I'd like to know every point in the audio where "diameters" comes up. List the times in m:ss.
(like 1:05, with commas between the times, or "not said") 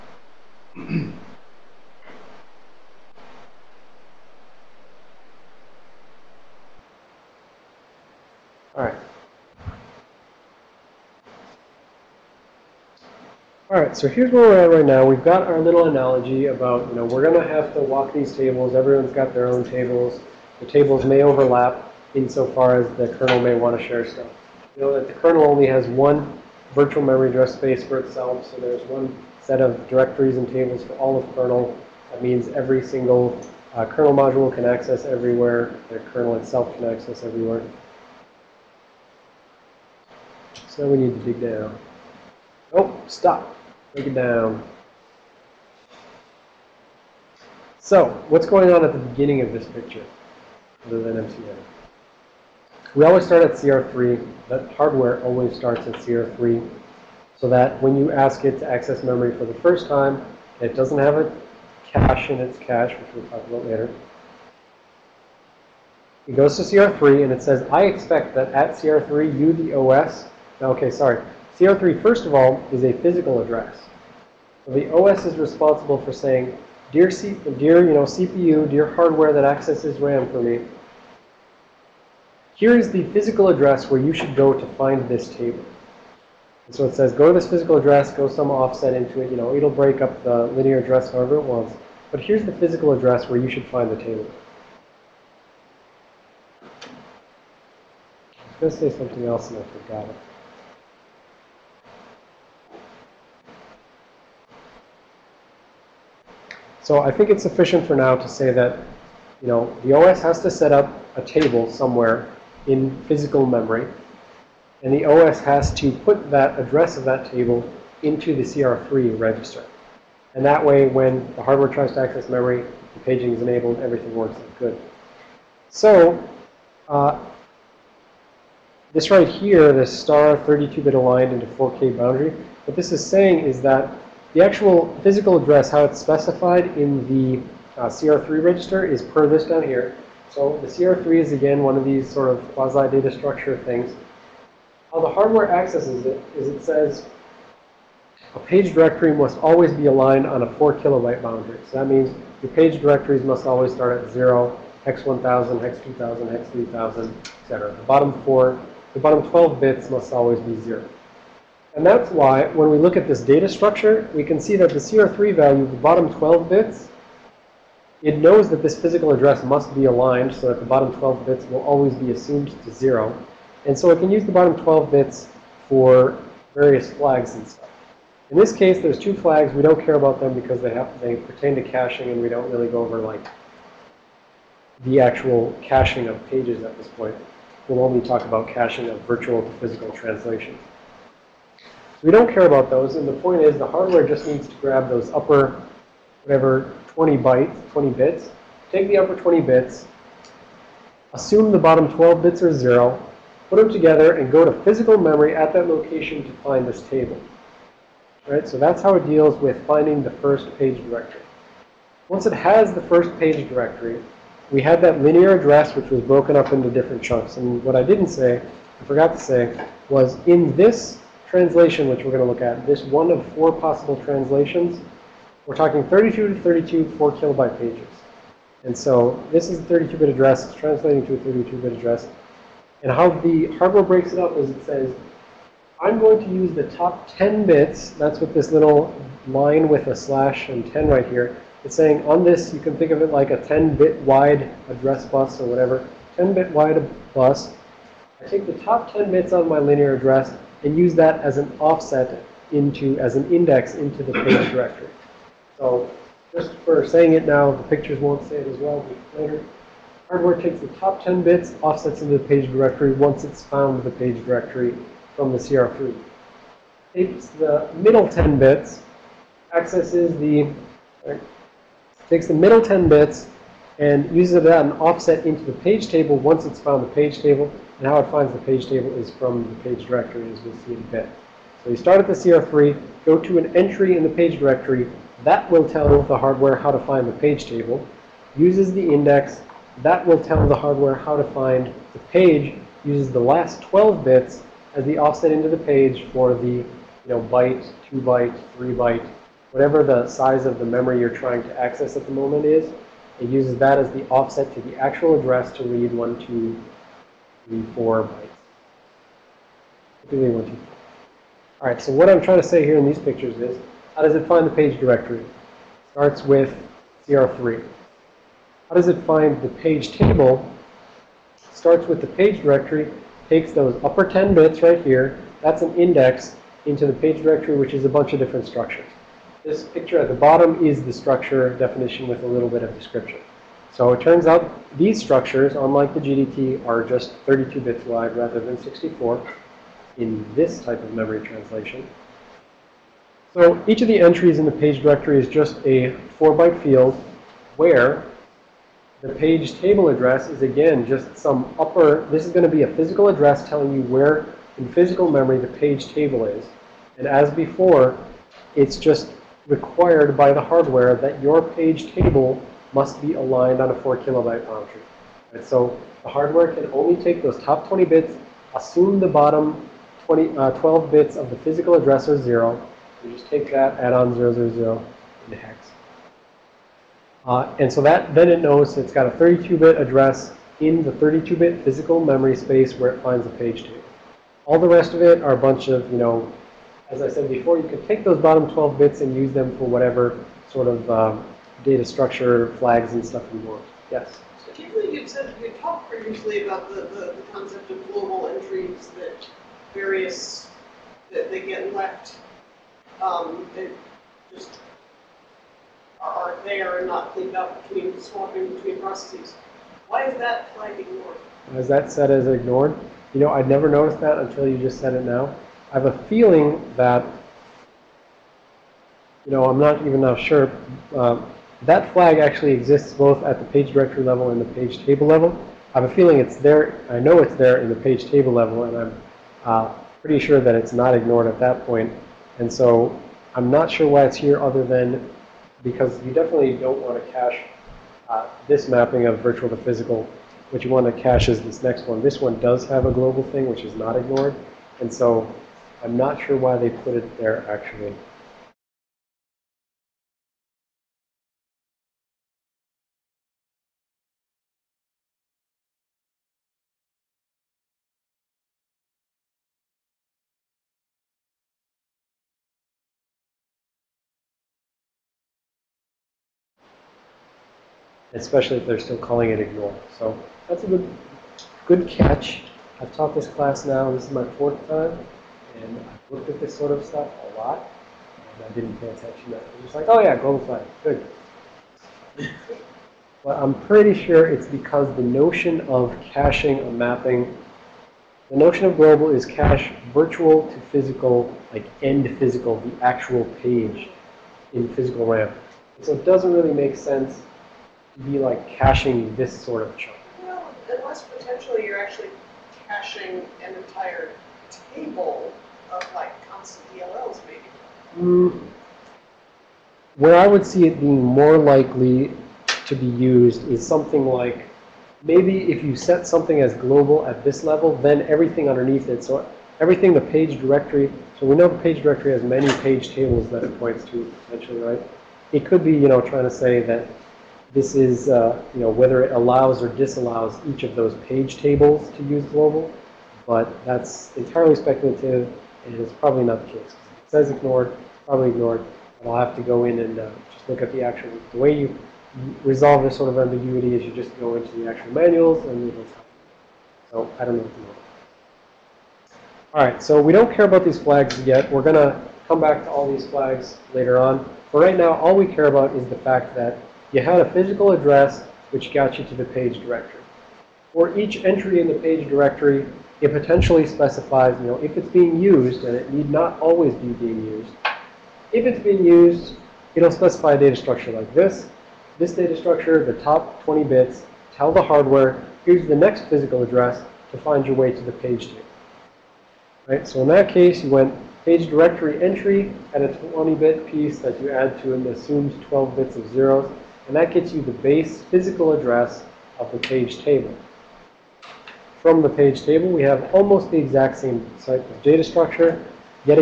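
not said.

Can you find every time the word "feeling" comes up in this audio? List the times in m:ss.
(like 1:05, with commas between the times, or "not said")
6:56, 7:05.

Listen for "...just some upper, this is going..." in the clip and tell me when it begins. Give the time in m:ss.
5:50.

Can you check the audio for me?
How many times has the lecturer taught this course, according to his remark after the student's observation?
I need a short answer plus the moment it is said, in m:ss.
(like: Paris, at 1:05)
4, at 7:54.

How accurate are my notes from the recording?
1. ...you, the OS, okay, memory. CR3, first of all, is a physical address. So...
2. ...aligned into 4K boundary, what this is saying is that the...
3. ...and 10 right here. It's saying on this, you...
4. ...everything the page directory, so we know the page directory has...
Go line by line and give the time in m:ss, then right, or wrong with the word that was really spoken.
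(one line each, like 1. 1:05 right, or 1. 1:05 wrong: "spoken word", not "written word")
1. 1:09 wrong: "sorry", not "memory"
2. 2:10 right
3. 4:00 right
4. 8:39 right.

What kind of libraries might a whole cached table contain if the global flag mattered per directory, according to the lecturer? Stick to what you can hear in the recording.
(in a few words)
constant DLLs.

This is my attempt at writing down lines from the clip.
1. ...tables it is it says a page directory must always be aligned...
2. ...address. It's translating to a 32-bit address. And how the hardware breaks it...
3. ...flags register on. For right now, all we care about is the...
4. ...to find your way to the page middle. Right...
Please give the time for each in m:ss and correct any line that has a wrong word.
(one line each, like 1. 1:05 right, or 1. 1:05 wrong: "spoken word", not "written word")
1. 2:25 wrong: "accesses", not "tables"
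2. 3:50 right
3. 9:13 wrong: "later", not "register"
4. 9:37 wrong: "table", not "middle".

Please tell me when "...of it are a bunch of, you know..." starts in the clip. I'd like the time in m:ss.
6:24.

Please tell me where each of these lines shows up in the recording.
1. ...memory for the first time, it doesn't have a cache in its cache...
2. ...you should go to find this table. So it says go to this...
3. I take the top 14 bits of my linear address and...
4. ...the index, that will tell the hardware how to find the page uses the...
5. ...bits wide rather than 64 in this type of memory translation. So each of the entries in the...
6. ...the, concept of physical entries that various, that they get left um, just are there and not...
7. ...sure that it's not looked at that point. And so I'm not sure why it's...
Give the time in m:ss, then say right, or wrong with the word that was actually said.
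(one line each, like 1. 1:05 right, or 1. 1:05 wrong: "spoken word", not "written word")
1. 0:59 right
2. 1:23 right
3. 4:08 wrong: "10", not "14"
4. 4:48 right
5. 5:37 right
6. 6:37 wrong: "global", not "physical"
7. 7:10 wrong: "ignored", not "looked".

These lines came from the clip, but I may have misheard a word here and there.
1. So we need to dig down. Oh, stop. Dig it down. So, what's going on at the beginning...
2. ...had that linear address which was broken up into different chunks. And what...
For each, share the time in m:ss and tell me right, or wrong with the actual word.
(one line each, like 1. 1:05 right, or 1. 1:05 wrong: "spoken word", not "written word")
1. 0:40 right
2. 3:34 right.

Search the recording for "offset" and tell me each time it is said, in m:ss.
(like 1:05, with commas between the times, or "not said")
1:28, 4:11, 4:21, 4:34, 4:54, 5:04.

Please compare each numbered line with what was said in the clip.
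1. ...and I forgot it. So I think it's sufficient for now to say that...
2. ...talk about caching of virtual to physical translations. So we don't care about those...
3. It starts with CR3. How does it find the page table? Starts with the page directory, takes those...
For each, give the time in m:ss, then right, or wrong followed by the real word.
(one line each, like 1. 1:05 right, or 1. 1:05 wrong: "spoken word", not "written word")
1. 1:39 right
2. 3:08 right
3. 5:15 right.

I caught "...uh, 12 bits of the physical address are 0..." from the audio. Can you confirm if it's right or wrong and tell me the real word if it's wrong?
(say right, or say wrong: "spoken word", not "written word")
right.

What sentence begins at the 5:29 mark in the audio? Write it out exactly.
This picture at the bottom is the structure definition with a little bit of description.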